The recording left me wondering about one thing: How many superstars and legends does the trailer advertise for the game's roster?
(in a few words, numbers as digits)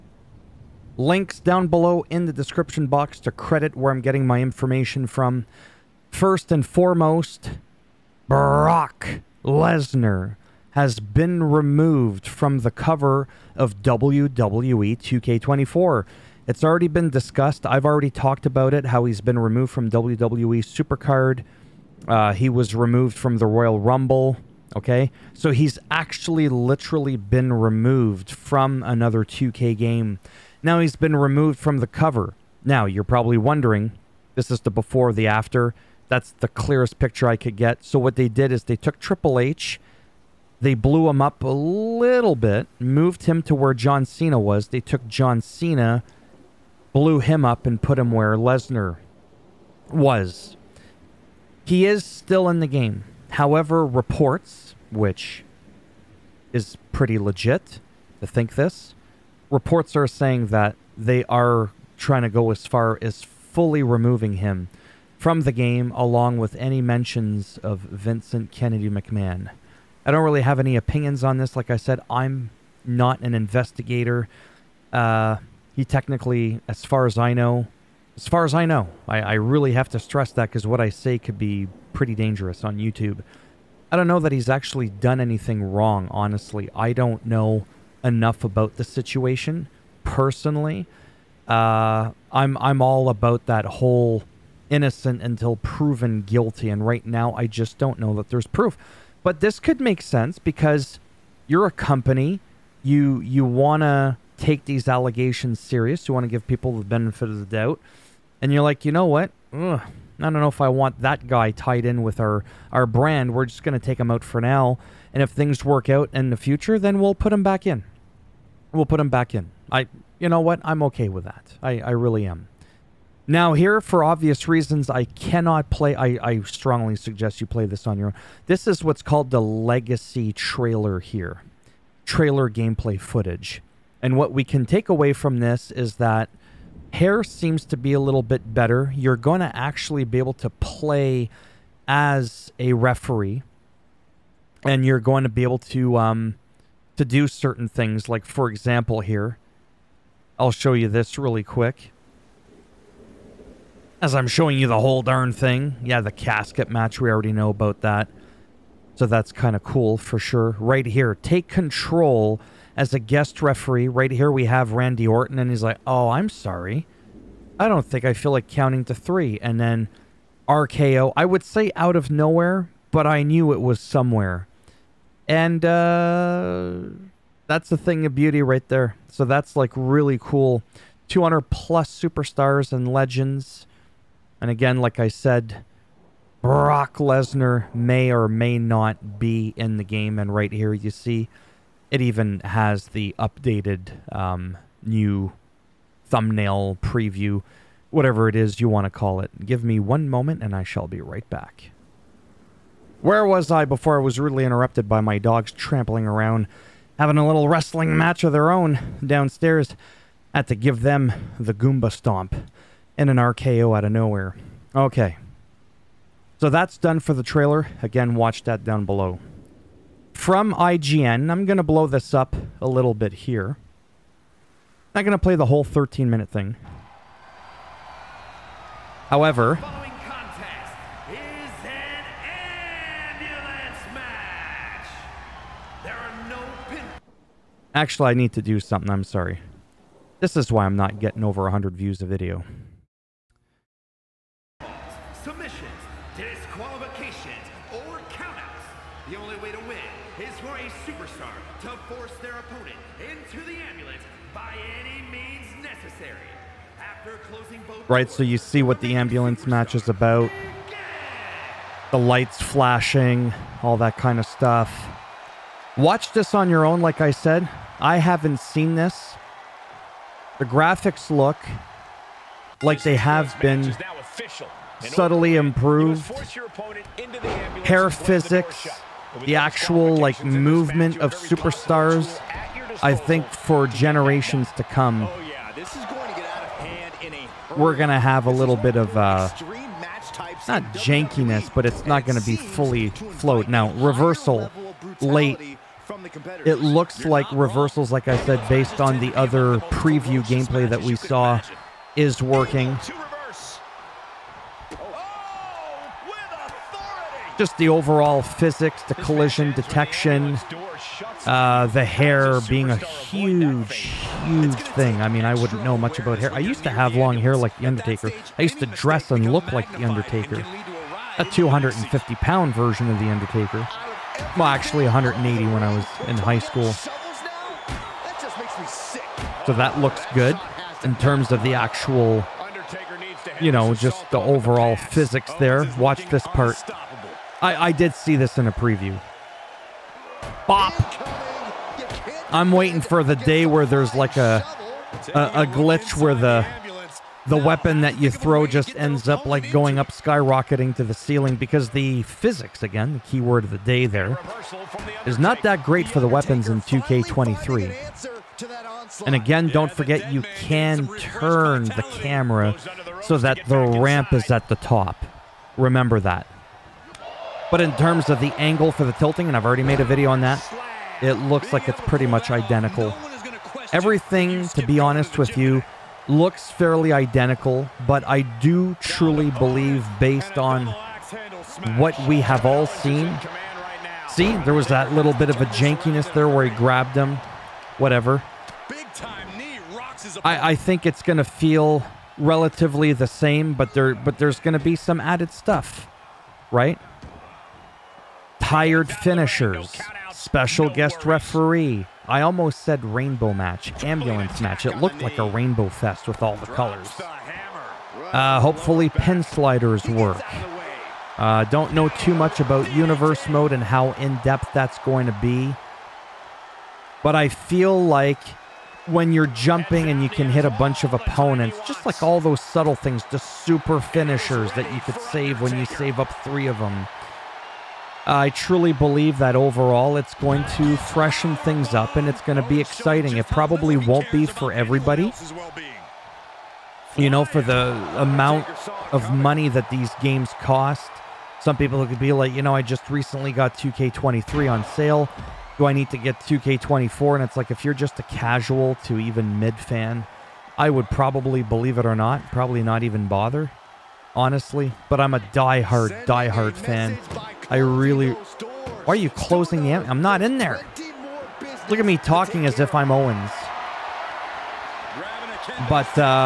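200 plus.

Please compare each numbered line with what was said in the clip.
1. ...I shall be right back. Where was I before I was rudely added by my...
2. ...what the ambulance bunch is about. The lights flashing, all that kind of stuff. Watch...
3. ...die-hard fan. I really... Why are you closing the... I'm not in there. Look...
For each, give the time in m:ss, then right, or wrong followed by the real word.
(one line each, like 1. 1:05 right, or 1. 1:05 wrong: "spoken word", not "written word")
1. 3:20 wrong: "interrupted", not "added"
2. 4:18 wrong: "match", not "bunch"
3. 7:36 right.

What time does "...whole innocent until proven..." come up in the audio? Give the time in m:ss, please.
1:33.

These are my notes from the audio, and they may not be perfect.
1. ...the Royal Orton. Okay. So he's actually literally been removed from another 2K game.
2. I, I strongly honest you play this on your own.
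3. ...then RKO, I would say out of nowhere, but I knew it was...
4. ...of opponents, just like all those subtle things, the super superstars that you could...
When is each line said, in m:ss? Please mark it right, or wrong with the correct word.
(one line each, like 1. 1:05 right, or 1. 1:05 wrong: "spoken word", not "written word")
1. 0:23 wrong: "Rumble", not "Orton"
2. 2:05 wrong: "suggest", not "honest"
3. 2:49 right
4. 7:00 wrong: "finishers", not "superstars".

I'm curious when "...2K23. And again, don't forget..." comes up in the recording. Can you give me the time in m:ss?
5:56.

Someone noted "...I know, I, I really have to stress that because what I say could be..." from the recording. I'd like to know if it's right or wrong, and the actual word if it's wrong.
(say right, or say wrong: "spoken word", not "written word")
right.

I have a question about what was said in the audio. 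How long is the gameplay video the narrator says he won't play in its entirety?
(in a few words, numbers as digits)
13 minutes.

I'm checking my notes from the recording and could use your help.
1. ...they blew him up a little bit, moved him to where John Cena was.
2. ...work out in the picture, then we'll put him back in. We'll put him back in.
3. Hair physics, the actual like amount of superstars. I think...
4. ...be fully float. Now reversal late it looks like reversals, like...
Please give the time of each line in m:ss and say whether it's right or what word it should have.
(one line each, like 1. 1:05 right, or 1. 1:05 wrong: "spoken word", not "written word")
1. 0:40 right
2. 1:55 wrong: "future", not "picture"
3. 4:37 wrong: "movement", not "amount"
4. 4:52 right.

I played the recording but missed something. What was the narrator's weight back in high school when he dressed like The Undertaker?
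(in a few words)
180.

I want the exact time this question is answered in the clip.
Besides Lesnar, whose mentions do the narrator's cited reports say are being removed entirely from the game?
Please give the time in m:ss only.
1:07.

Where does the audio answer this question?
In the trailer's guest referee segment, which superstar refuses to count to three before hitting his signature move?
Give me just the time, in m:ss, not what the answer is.
2:44.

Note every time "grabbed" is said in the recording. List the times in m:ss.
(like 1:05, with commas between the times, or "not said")
6:26.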